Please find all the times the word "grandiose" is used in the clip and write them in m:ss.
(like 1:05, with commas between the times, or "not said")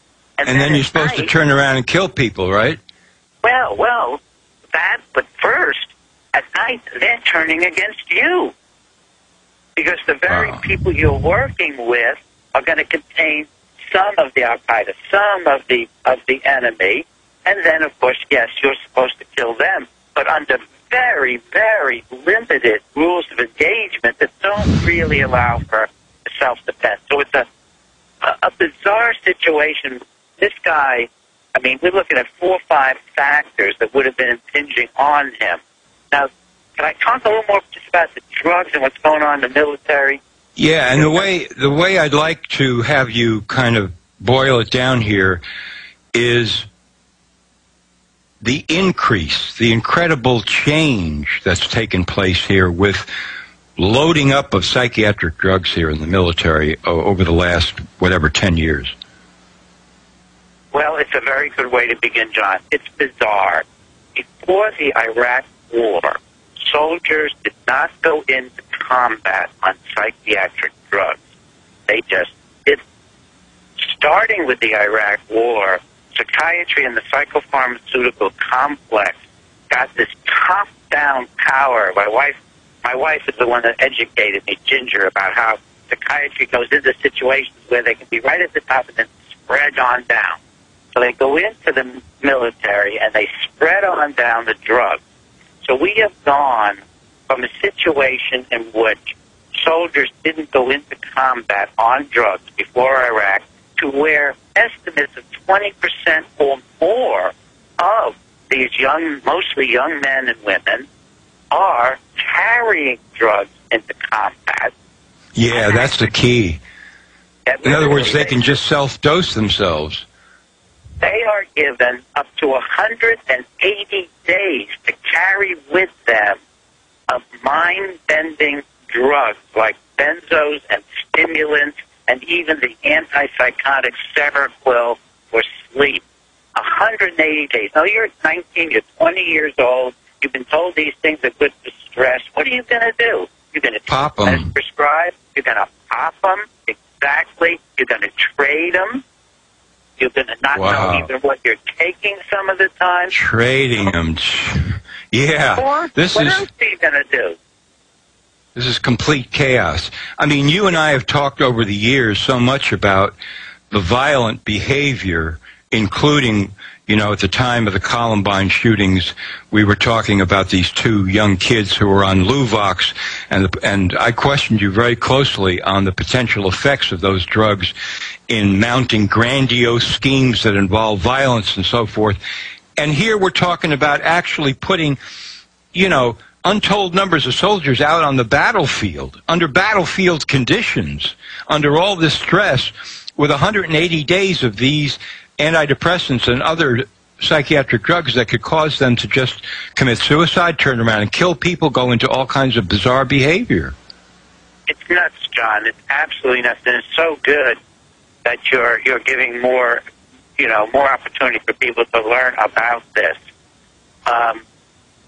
2:59.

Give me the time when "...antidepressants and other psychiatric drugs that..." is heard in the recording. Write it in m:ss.
3:15.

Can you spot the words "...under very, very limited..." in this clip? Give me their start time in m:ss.
0:20.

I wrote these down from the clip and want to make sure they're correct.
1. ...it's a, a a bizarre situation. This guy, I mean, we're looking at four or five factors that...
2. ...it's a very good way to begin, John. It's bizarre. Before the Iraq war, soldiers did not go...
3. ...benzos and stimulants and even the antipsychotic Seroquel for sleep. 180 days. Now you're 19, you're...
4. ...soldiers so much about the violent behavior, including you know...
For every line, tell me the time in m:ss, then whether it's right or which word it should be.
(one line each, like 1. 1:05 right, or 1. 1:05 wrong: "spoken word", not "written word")
1. 0:27 right
2. 1:00 right
3. 2:09 right
4. 2:41 wrong: "years", not "soldiers".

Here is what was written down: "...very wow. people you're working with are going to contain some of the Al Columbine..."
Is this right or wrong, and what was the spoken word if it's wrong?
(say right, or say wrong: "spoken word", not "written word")
wrong: "Qaeda", not "Columbine".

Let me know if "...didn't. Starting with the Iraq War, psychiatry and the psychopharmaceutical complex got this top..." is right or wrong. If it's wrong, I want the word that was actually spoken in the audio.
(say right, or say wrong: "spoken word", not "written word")
right.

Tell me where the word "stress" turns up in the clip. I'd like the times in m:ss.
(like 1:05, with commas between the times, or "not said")
2:21, 3:12.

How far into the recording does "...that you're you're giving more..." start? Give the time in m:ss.
3:28.